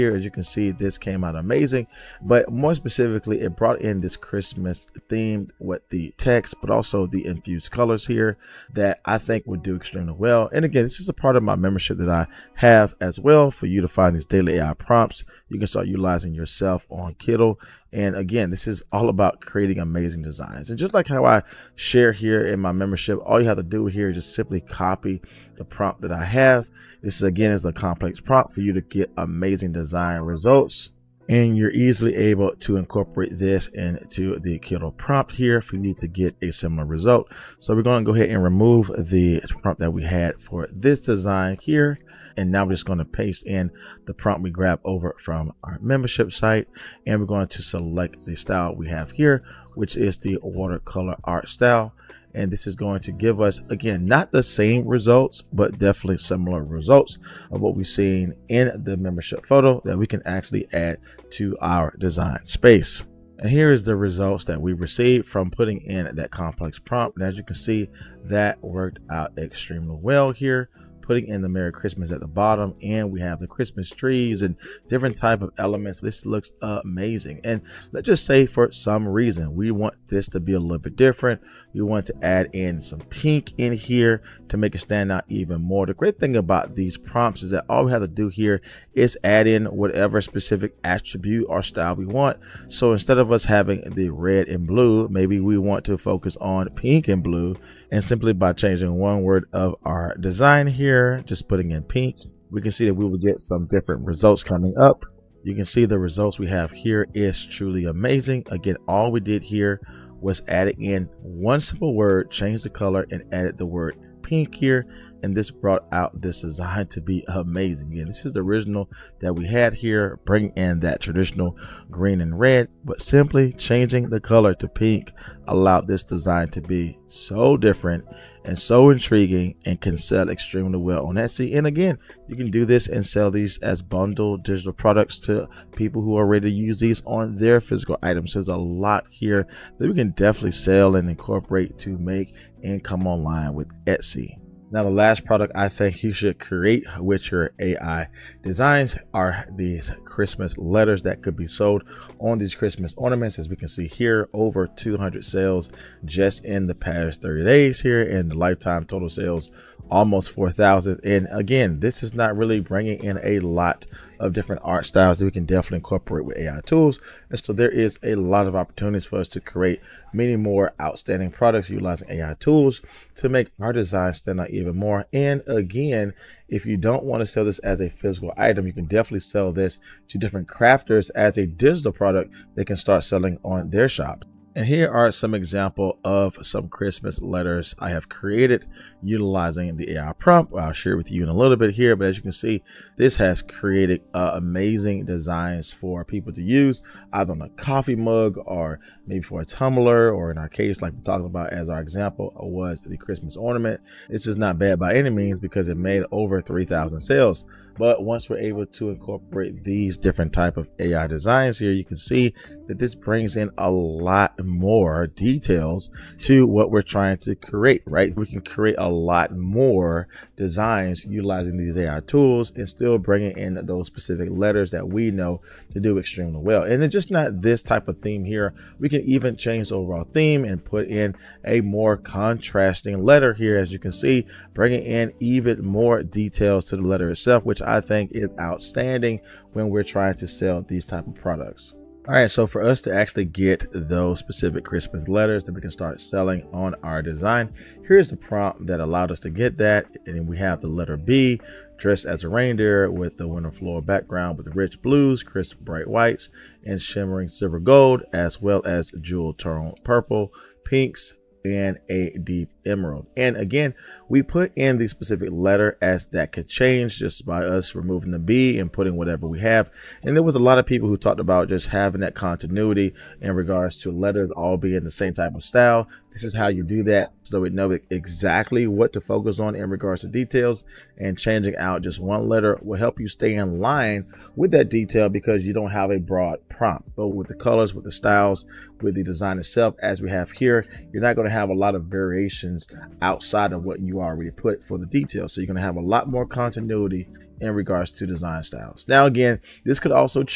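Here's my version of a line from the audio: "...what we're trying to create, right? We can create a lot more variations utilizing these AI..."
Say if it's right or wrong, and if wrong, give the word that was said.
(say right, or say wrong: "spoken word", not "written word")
wrong: "designs", not "variations".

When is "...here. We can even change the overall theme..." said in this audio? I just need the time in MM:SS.
03:48.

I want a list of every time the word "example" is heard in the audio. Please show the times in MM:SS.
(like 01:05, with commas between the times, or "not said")
03:05, 03:21.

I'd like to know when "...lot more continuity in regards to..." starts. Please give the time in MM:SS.
04:55.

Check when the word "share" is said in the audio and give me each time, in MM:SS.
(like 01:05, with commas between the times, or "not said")
00:21, 03:10.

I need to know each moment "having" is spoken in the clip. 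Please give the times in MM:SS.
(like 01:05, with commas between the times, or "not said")
01:33, 04:31.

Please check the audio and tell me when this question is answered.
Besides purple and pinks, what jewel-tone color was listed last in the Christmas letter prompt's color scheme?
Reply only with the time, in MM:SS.
04:22.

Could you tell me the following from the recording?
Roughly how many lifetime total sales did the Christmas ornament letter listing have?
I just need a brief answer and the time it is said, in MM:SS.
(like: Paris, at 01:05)
4,000, at 02:39.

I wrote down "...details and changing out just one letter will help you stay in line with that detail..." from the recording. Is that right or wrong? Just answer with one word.
right.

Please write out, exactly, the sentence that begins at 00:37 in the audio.
So we're going to go ahead and remove the prompt that we had for this design here.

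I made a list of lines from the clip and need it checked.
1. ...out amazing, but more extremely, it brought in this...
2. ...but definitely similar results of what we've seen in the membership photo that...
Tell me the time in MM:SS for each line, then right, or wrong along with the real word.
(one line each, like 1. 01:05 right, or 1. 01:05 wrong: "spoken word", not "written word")
1. 00:01 wrong: "specifically", not "extremely"
2. 00:55 right.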